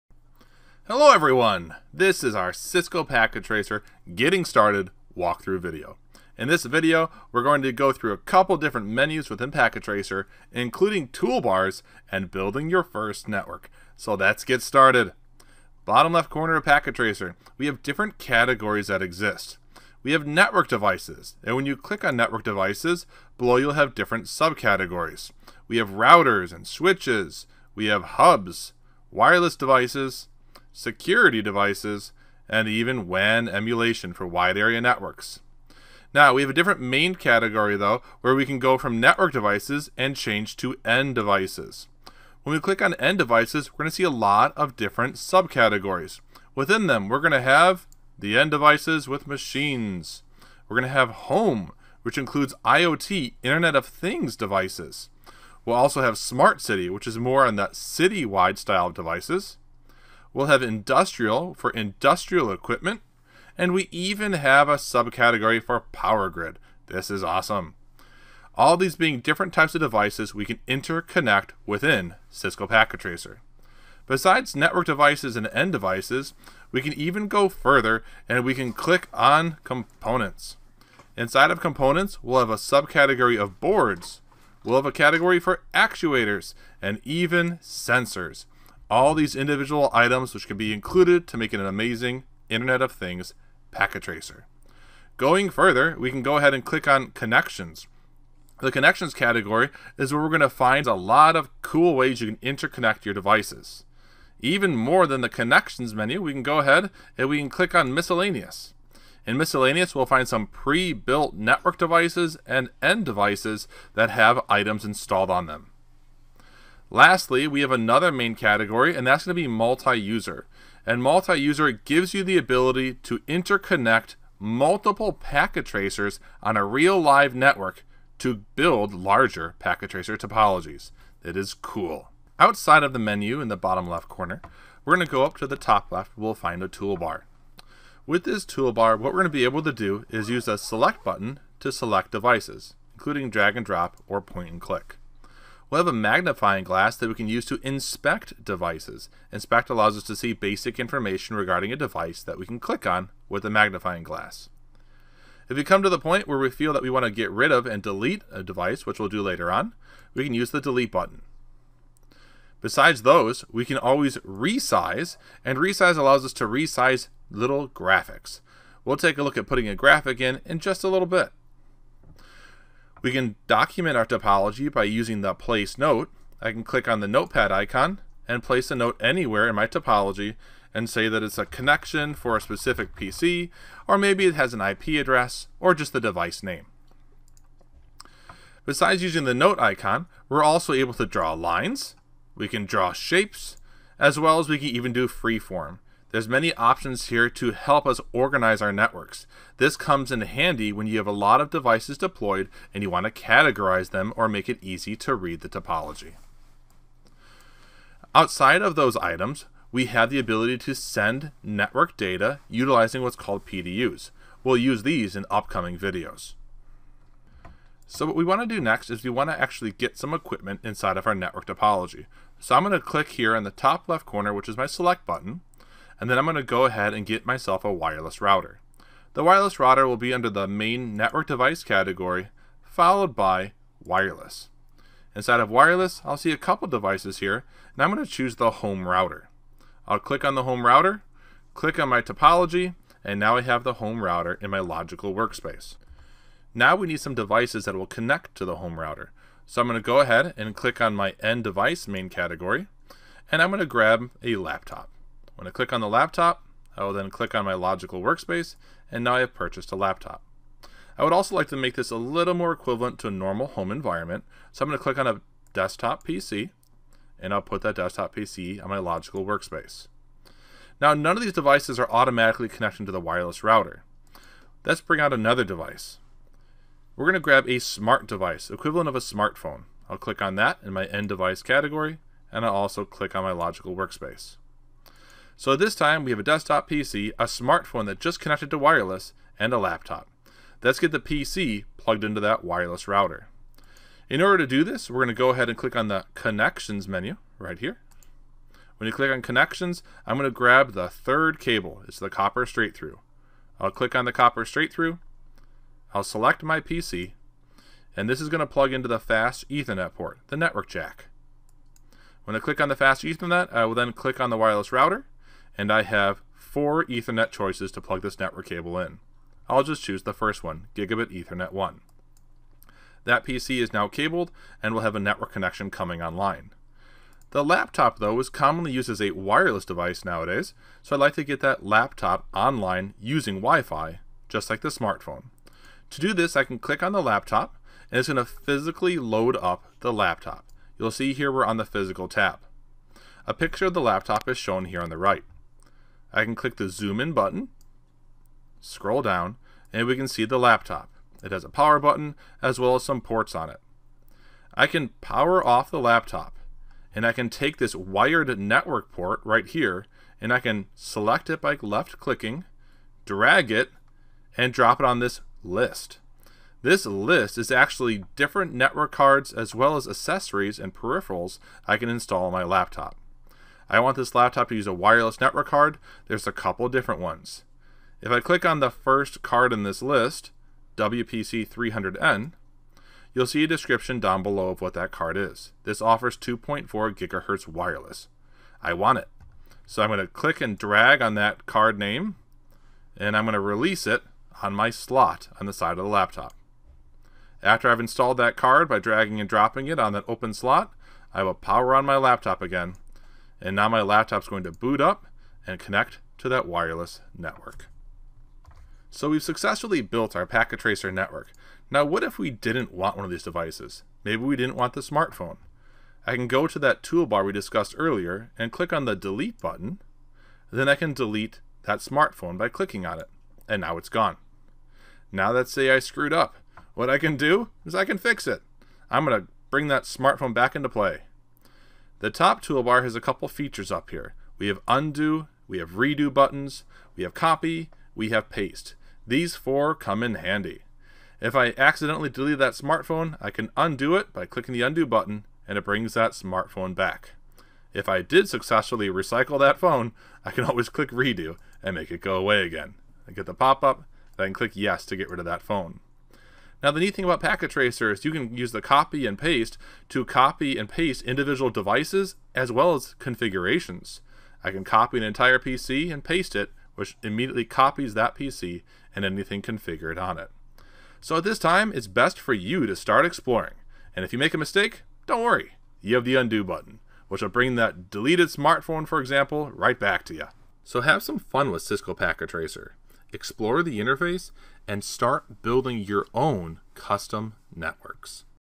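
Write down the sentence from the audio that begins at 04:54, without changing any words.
In order to do this, we're going to go ahead and click on the connections menu right here.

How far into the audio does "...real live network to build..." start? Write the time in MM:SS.
02:06.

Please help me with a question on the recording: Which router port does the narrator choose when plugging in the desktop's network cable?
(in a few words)
Gigabit Ethernet 1.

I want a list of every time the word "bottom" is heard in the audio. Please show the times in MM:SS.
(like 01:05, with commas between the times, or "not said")
00:15, 02:13.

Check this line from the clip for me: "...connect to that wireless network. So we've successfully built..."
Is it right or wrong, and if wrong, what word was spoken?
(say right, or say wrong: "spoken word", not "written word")
right.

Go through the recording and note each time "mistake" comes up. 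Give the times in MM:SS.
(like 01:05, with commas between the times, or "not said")
07:54.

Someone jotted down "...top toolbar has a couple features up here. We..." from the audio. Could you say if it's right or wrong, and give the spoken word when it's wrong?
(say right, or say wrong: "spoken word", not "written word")
right.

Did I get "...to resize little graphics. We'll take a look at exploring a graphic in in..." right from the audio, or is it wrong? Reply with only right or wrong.
wrong.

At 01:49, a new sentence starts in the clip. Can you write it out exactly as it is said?
In miscellaneous, we'll find some pre-built network devices and end devices that have items installed on them.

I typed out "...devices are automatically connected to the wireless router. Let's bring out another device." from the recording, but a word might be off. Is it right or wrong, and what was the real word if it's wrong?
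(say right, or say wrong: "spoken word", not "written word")
right.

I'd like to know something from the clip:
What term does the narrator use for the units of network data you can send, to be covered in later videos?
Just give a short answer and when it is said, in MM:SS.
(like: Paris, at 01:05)
PDUs, at 03:33.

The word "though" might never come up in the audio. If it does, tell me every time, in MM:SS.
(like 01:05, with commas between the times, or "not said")
00:37, 05:27.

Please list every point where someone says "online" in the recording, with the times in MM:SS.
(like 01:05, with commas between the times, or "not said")
05:26, 05:32.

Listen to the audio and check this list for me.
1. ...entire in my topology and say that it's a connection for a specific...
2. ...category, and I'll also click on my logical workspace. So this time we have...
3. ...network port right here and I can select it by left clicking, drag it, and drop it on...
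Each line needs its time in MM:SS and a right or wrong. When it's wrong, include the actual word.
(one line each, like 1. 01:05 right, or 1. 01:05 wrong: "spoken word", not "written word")
1. 02:59 wrong: "anywhere", not "entire"
2. 04:41 right
3. 05:58 right.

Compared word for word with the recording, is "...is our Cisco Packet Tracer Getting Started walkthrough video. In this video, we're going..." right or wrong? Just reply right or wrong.
right.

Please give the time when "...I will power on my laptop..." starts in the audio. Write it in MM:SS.
06:41.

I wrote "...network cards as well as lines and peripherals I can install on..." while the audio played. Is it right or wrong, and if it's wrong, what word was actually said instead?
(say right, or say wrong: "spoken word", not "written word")
wrong: "accessories", not "lines".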